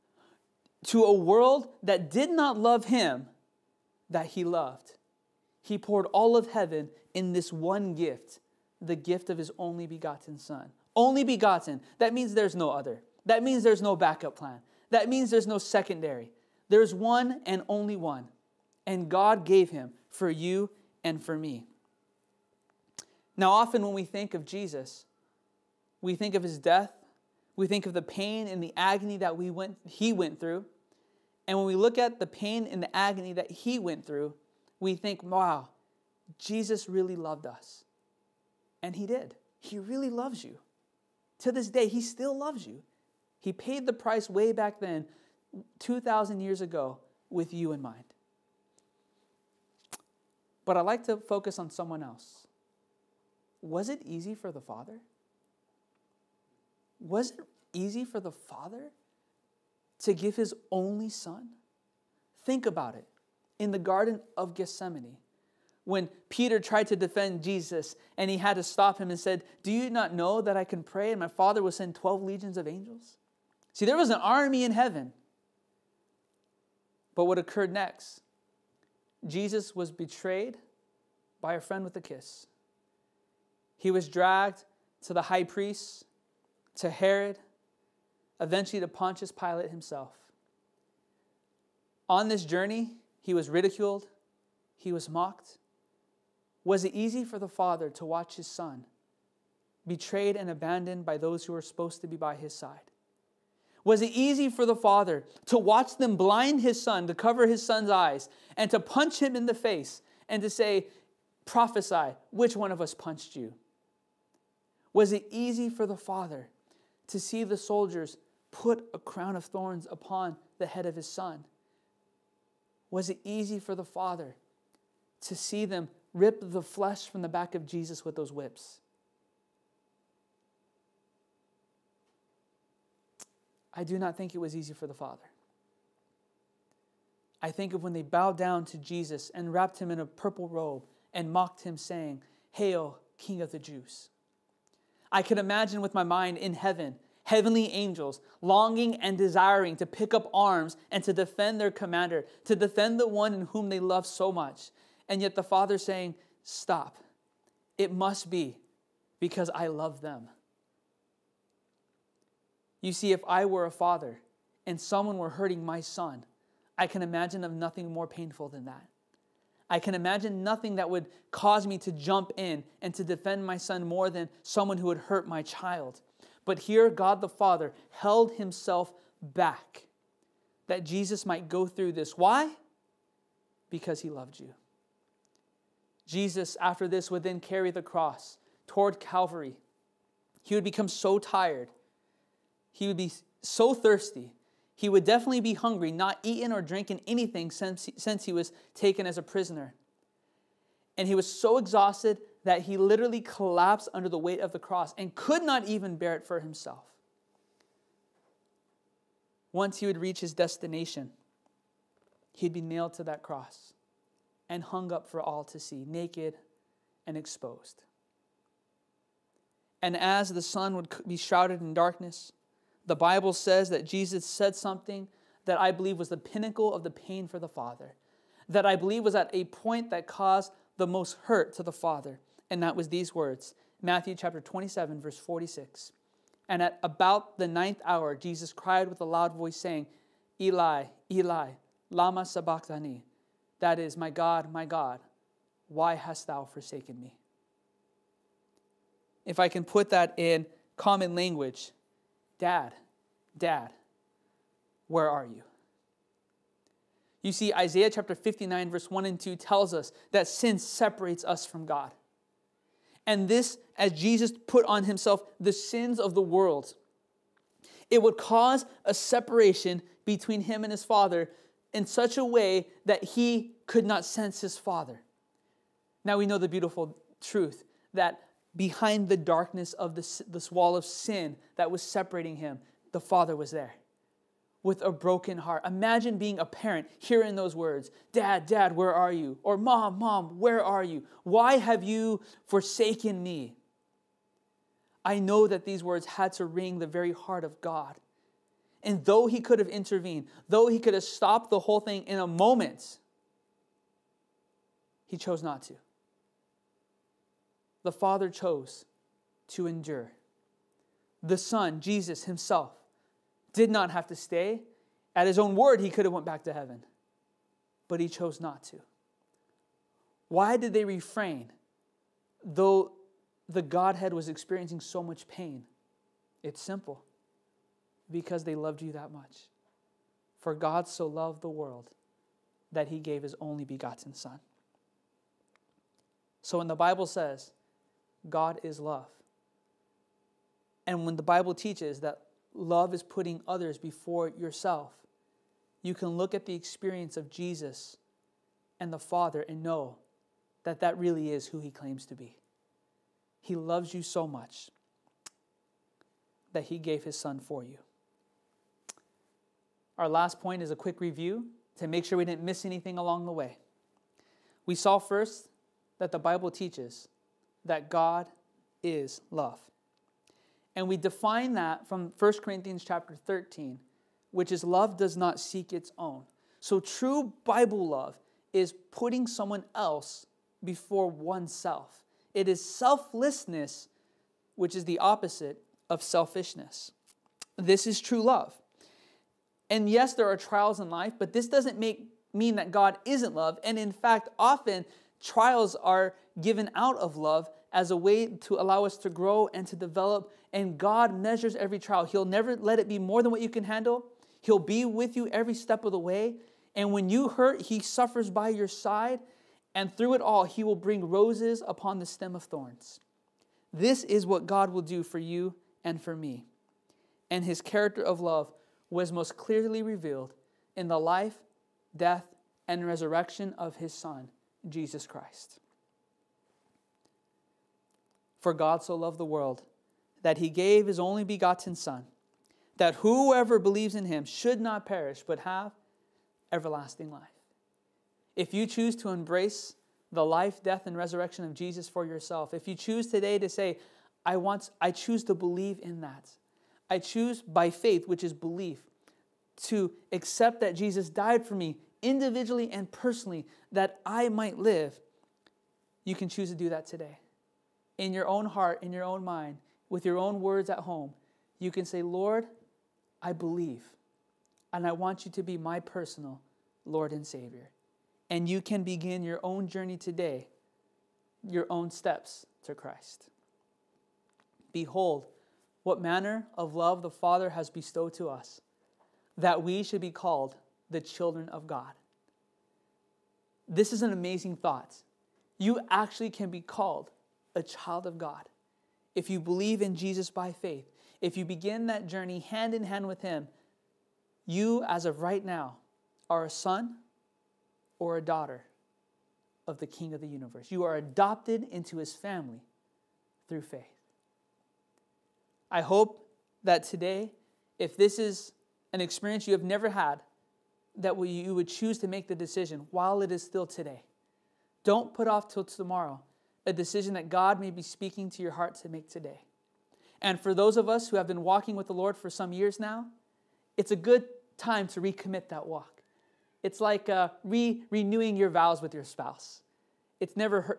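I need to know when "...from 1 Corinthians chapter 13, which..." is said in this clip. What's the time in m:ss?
6:11.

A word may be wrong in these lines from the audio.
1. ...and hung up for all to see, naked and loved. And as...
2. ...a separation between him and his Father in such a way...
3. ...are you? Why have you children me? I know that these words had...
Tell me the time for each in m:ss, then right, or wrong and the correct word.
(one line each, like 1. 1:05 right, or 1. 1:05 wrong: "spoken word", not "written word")
1. 3:34 wrong: "exposed", not "loved"
2. 4:28 right
3. 4:50 wrong: "forsaken", not "children".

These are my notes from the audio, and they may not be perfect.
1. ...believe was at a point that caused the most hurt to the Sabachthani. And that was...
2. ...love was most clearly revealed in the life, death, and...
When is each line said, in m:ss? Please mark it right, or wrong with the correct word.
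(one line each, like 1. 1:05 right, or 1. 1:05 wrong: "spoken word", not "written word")
1. 3:48 wrong: "Father", not "Sabachthani"
2. 6:58 right.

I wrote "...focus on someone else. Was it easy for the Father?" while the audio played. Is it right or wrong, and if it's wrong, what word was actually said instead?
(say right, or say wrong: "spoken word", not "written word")
right.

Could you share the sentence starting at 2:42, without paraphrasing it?
You see, if I were a father and someone were hurting my son, I can imagine of nothing more painful than that.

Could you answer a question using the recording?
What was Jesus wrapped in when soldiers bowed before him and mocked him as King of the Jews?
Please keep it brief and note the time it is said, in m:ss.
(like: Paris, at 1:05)
A purple robe, at 2:20.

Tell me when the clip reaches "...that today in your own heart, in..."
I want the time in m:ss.
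7:36.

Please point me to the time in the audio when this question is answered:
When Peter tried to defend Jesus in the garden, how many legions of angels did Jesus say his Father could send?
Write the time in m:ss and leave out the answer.
1:11.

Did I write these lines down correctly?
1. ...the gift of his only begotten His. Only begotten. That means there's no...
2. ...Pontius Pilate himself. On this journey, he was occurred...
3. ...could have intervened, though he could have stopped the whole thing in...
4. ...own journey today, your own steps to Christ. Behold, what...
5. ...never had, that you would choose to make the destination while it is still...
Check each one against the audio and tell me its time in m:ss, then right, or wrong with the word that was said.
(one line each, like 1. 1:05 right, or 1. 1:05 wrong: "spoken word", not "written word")
1. 0:08 wrong: "Son", not "His"
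2. 1:28 wrong: "ridiculed", not "occurred"
3. 4:59 right
4. 7:49 right
5. 8:29 wrong: "decision", not "destination".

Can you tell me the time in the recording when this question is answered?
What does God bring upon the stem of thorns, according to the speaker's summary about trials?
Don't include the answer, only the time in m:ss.
6:51.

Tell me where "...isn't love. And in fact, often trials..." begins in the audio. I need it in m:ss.
6:33.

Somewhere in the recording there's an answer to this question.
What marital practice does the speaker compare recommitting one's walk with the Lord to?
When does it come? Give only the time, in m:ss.
8:47.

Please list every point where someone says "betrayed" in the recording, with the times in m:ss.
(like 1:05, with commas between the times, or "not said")
1:19, 1:39.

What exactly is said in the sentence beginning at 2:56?
But here, God the Father held himself back that Jesus might go through this.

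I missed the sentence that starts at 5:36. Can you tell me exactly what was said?
So when the Bible says God is love.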